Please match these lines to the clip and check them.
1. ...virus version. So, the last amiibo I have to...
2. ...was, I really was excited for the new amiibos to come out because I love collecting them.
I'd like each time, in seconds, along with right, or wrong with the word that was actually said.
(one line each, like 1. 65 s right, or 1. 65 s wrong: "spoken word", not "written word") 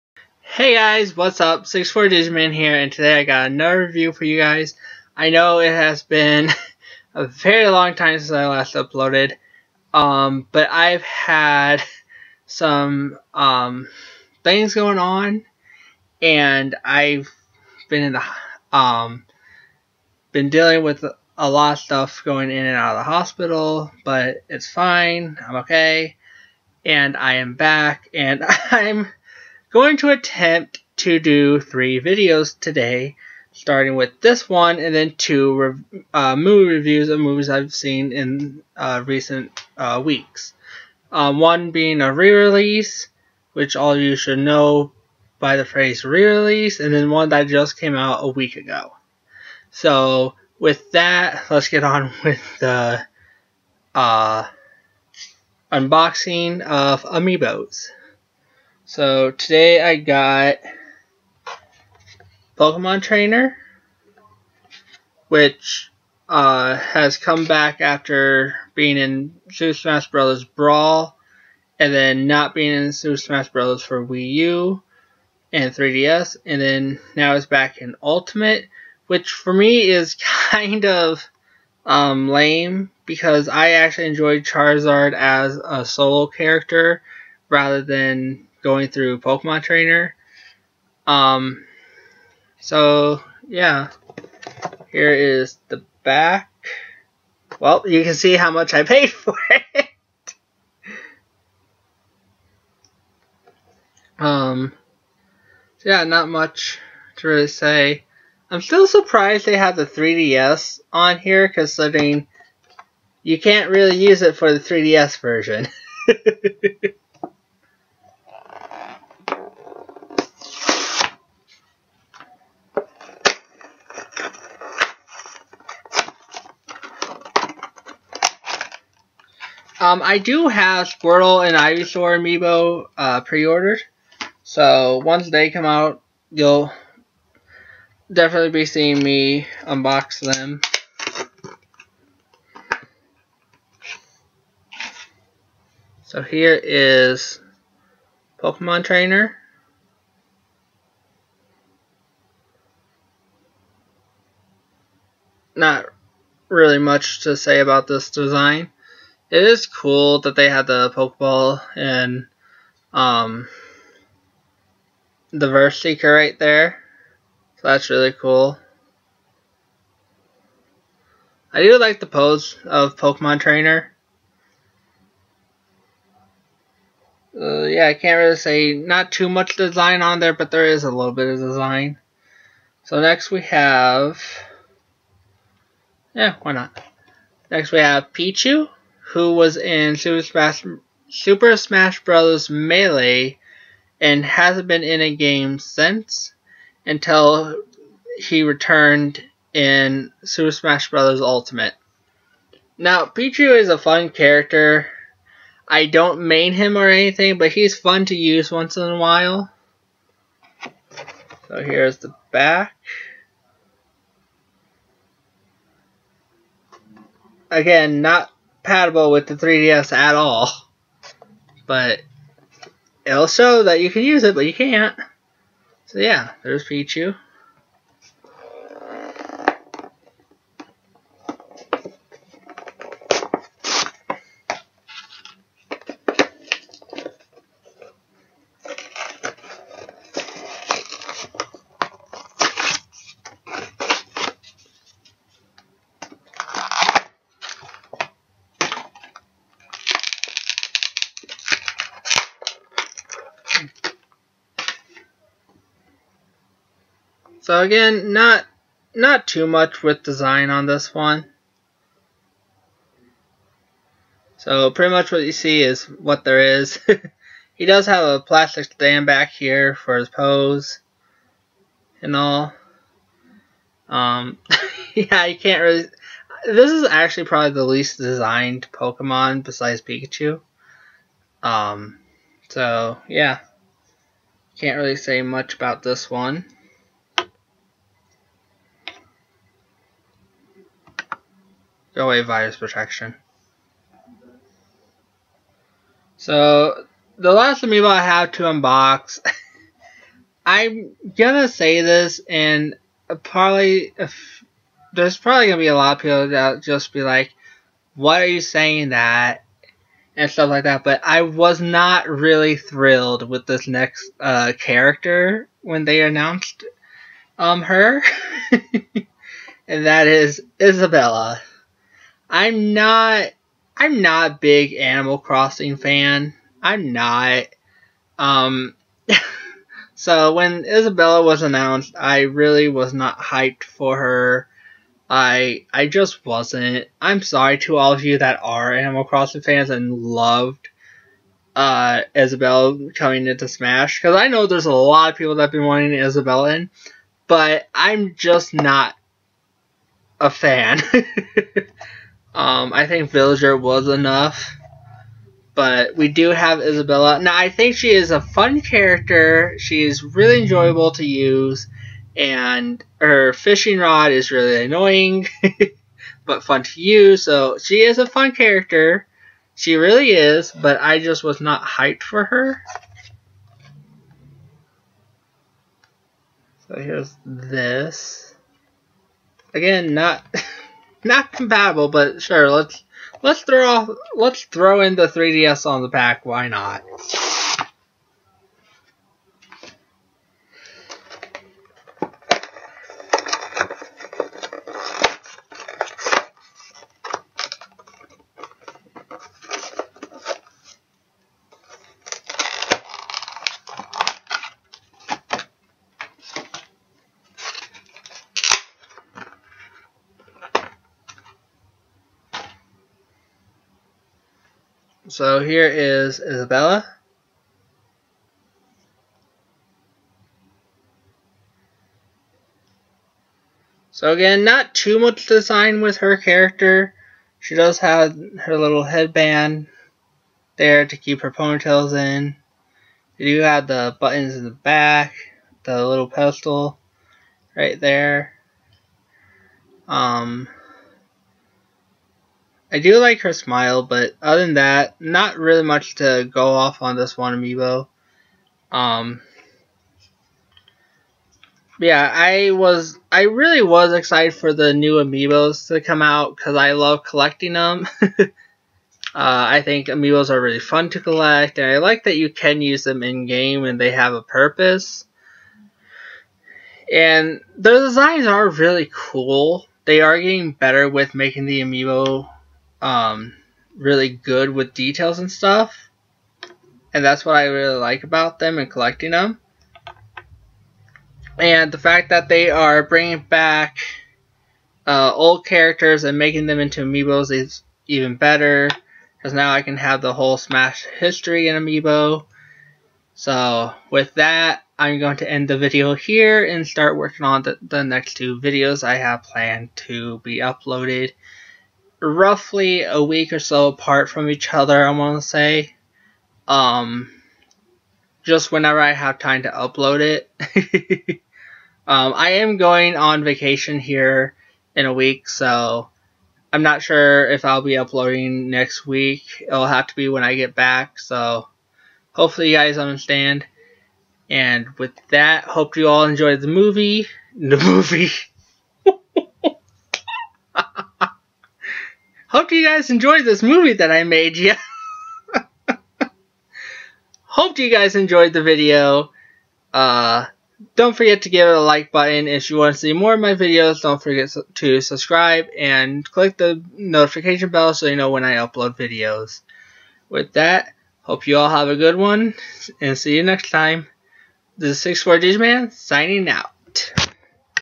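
1. 292 s wrong: "protection", not "version"
2. 452 s right.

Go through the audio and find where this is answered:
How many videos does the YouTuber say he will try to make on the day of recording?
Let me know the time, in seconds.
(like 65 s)
31 s.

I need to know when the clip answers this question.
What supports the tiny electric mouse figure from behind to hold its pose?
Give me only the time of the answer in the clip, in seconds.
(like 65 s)
268 s.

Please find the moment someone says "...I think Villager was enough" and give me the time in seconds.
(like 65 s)
352 s.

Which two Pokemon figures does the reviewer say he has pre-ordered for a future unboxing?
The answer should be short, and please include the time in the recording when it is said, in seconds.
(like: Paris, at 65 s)
Squirtle and Ivysaur, at 130 s.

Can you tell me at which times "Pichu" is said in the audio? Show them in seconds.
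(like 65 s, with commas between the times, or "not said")
188 s, 203 s, 226 s.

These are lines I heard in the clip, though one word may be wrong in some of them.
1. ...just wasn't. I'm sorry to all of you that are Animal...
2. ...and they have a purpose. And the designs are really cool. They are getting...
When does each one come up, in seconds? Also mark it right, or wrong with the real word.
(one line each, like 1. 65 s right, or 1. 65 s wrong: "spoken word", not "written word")
1. 335 s right
2. 463 s right.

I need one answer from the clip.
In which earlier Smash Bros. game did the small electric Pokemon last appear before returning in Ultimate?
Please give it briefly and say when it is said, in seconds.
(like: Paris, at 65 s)
Super Smash Bros. Melee, at 191 s.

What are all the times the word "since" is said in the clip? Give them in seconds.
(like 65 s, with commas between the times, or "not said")
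8 s, 195 s.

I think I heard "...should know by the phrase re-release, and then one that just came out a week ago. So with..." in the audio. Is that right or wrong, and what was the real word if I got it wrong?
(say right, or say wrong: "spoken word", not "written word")
right.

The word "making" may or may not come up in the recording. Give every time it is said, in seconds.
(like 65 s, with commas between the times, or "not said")
471 s, 486 s.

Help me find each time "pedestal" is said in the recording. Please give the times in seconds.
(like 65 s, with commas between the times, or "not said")
436 s.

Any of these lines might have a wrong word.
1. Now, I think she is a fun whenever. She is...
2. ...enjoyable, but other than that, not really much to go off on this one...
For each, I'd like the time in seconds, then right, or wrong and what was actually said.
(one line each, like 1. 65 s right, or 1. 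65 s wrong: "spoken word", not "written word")
1. 357 s wrong: "character", not "whenever"
2. 443 s wrong: "smile", not "enjoyable".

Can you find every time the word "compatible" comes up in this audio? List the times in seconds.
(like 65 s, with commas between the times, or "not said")
218 s, 381 s.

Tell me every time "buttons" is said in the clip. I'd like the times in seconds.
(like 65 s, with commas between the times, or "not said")
433 s, 541 s.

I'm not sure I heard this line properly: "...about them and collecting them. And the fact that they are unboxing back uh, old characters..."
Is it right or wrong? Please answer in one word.
wrong.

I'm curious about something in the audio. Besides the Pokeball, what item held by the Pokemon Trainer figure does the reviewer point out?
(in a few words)
VS Seeker.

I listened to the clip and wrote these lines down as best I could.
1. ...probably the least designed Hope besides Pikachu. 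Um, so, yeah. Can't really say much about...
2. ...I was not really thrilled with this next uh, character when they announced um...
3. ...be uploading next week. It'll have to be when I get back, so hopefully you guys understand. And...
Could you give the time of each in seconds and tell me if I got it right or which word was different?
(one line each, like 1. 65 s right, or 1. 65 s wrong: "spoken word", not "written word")
1. 277 s wrong: "Pokemon", not "Hope"
2. 311 s right
3. 517 s right.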